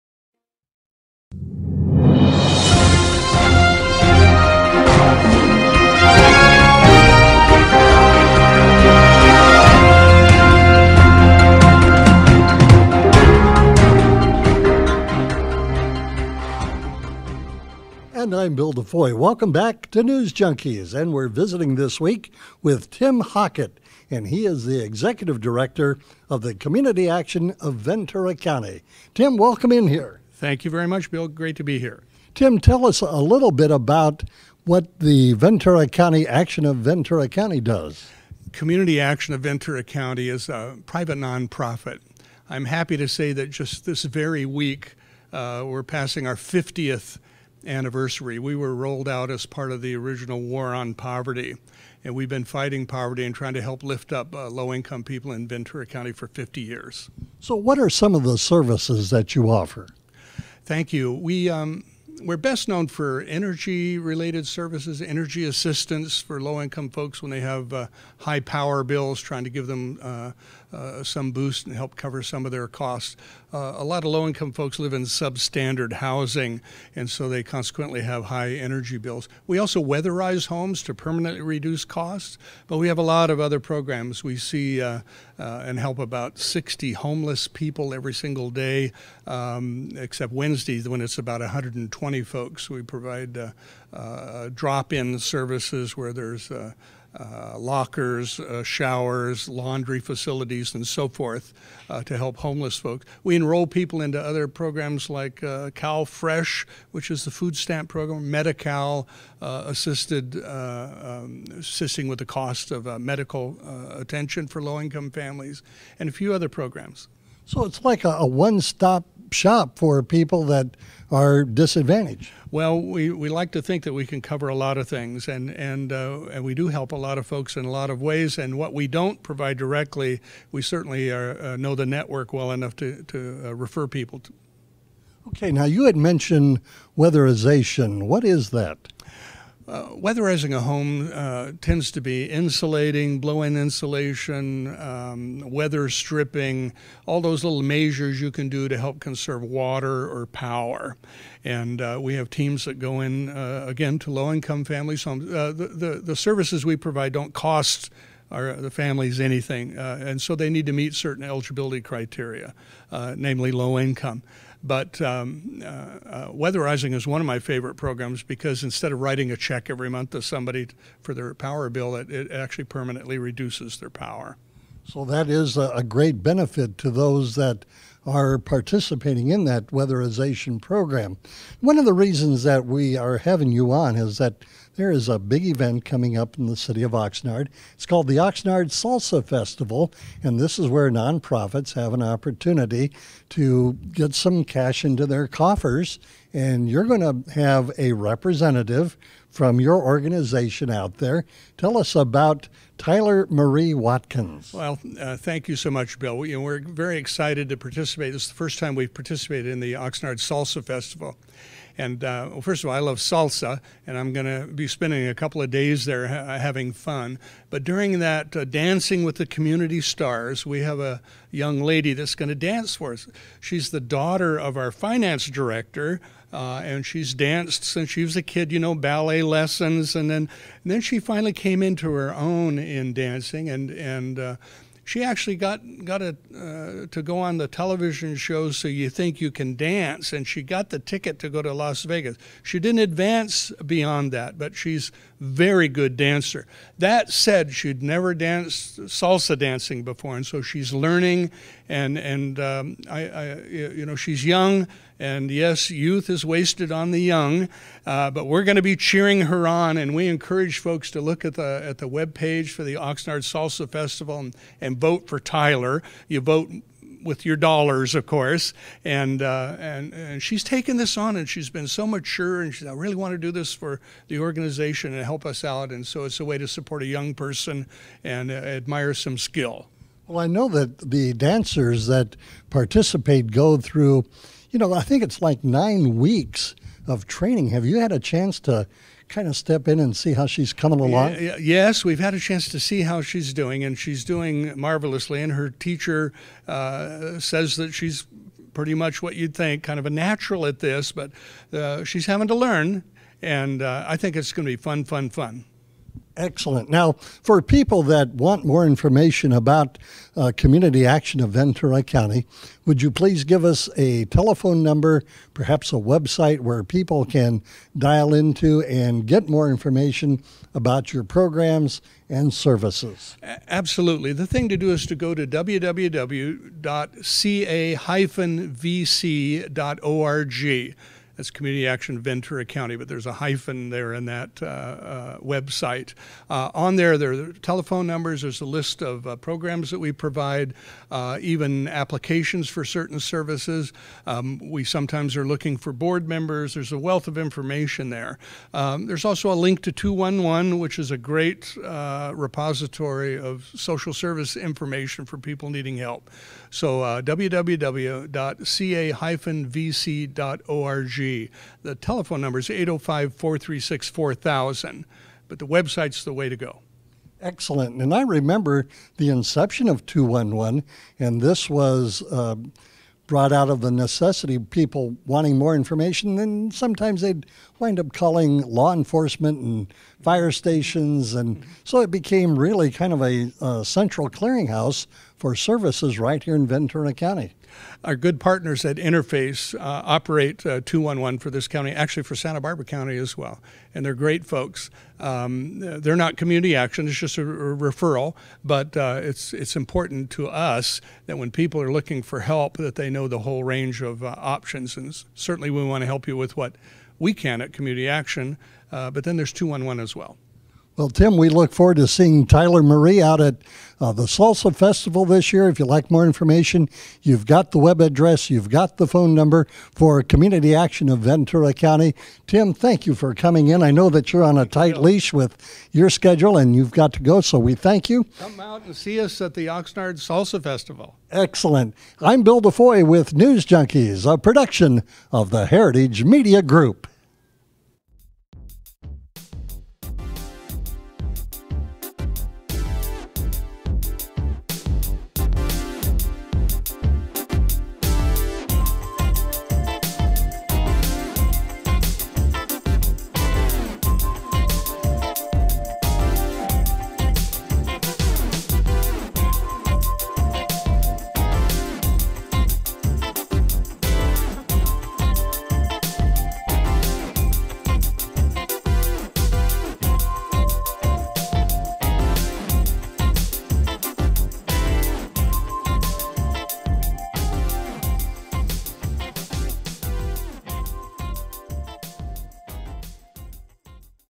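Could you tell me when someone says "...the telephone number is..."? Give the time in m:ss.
6:01.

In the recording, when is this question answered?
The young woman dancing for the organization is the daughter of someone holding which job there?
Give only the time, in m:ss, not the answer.
3:44.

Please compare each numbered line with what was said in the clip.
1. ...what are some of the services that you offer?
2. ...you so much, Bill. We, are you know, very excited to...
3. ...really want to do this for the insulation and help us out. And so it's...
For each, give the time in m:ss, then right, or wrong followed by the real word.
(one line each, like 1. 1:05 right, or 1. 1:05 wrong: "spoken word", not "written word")
1. 0:57 right
2. 3:25 right
3. 4:32 wrong: "organization", not "insulation".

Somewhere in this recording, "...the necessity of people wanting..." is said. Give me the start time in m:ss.
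6:13.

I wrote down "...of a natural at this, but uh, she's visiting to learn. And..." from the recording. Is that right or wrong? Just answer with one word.
wrong.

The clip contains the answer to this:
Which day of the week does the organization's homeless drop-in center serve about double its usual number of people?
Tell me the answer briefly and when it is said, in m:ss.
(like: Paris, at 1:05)
Wednesdays, at 1:30.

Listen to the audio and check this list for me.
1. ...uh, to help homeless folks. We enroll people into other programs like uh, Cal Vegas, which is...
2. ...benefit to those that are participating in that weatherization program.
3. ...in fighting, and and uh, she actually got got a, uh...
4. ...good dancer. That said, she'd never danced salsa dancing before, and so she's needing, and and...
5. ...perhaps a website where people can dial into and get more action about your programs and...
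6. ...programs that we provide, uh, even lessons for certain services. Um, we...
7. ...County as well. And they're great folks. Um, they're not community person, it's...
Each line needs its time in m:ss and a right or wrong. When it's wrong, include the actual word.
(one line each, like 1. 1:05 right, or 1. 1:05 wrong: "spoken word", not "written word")
1. 1:41 wrong: "Fresh", not "Vegas"
2. 2:56 right
3. 3:52 wrong: "dancing", not "fighting"
4. 4:05 wrong: "learning", not "needing"
5. 5:15 wrong: "information", not "action"
6. 5:39 wrong: "applications", not "lessons"
7. 6:32 wrong: "action", not "person".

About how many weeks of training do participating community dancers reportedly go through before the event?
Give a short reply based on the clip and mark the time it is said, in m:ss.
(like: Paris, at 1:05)
9, at 4:45.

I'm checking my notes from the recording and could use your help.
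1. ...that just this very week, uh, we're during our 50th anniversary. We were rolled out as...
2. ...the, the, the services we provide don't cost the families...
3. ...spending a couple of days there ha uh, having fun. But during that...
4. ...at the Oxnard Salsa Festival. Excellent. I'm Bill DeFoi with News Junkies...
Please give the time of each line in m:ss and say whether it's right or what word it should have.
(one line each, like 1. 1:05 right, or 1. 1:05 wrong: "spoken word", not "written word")
1. 0:43 wrong: "passing", not "during"
2. 2:35 right
3. 3:34 right
4. 7:09 right.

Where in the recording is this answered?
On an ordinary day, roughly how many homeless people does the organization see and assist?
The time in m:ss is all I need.
1:26.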